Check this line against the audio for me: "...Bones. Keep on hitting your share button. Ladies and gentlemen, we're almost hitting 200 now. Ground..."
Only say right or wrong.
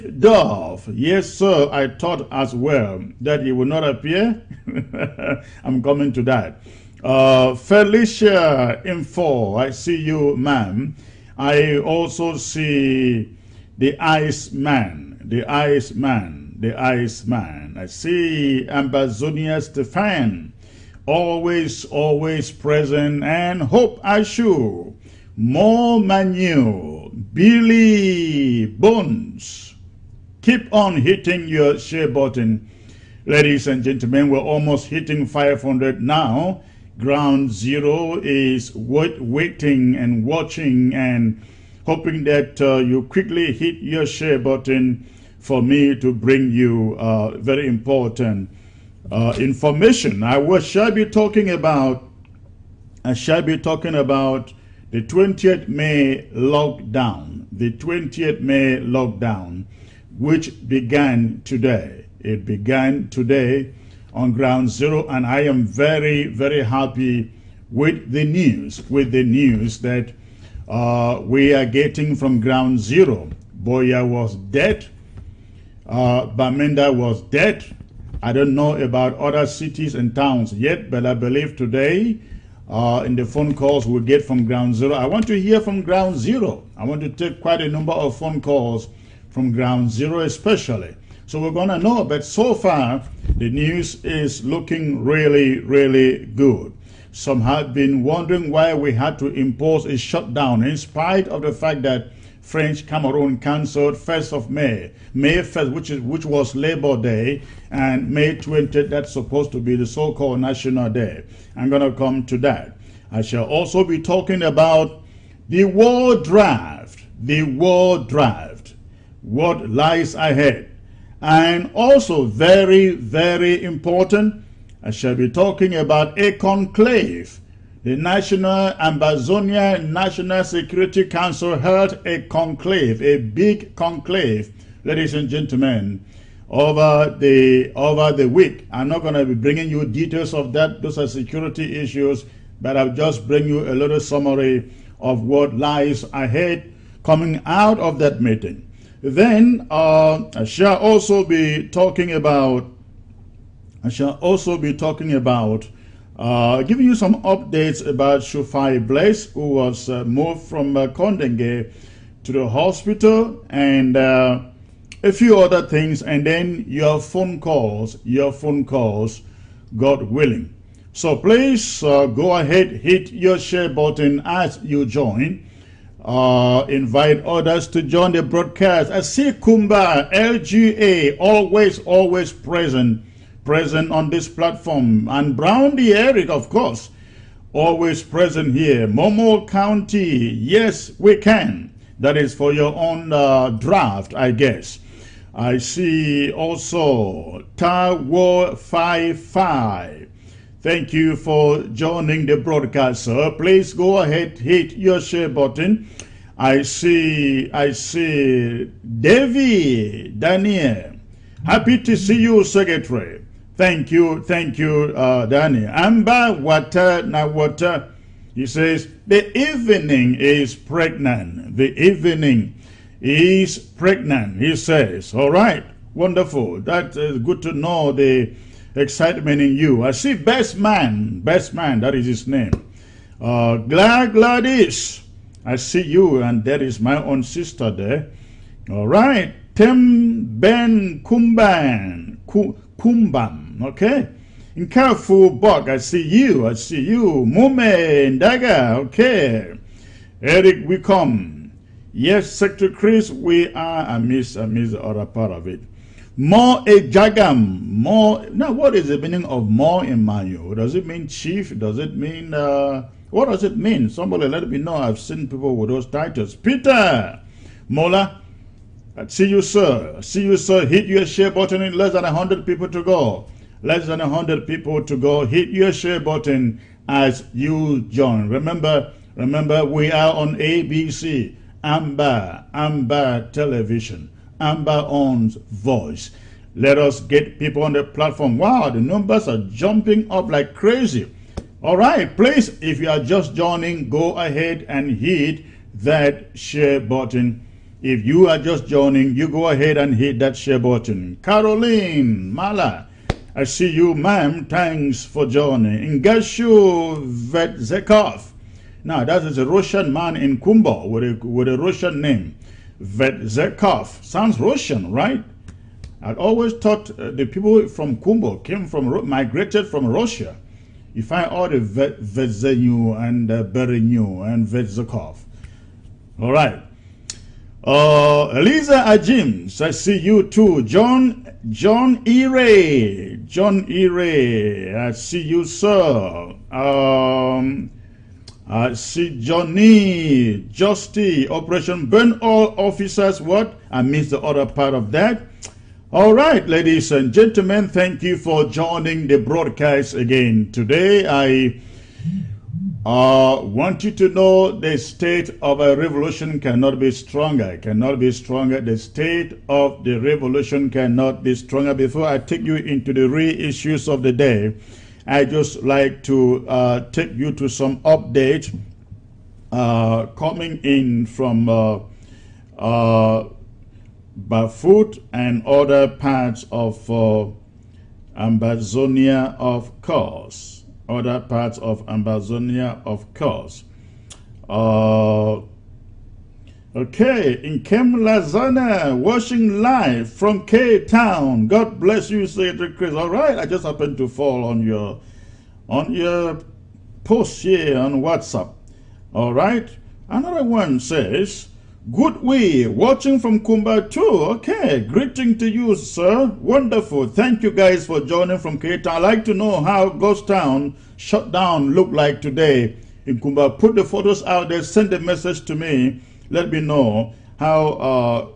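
wrong.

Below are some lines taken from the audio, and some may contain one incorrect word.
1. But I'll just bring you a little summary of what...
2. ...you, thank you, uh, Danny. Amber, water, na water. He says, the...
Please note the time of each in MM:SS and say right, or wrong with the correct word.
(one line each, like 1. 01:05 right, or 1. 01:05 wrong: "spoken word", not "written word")
1. 02:22 right
2. 03:33 right.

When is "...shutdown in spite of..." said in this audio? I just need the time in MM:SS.
01:39.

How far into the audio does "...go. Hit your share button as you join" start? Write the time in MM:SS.
04:34.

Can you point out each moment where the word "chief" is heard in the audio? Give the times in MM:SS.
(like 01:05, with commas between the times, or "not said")
04:21.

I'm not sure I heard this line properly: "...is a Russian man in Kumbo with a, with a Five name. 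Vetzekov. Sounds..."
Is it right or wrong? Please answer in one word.
wrong.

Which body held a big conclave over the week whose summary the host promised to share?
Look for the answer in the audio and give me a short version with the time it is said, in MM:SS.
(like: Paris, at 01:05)
Ambazonia National Security Council, at 02:08.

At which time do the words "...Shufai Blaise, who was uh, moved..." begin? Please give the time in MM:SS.
02:38.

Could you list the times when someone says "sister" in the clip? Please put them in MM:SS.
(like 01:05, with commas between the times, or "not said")
03:57.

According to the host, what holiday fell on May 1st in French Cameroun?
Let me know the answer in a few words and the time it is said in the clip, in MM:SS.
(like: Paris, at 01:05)
Labor Day, at 01:46.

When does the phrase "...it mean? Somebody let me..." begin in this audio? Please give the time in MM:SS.
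04:23.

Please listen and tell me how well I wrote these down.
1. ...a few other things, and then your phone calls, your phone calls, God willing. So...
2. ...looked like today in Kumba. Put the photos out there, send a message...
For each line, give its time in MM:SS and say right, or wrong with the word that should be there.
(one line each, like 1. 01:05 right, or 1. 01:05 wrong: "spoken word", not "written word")
1. 02:45 right
2. 06:51 right.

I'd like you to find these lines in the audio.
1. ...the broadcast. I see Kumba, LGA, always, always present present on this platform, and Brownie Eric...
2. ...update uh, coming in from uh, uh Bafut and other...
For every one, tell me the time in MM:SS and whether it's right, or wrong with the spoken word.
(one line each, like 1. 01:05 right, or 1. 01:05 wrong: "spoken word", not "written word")
1. 02:58 right
2. 06:07 right.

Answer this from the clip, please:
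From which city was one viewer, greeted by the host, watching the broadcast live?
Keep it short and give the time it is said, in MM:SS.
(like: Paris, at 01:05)
Cape Town, at 06:30.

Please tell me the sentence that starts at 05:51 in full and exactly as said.
I I uh, want you to know the state of a revolution cannot be stronger, cannot be stronger.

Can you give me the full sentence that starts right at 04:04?
In careful, Buck, I see you.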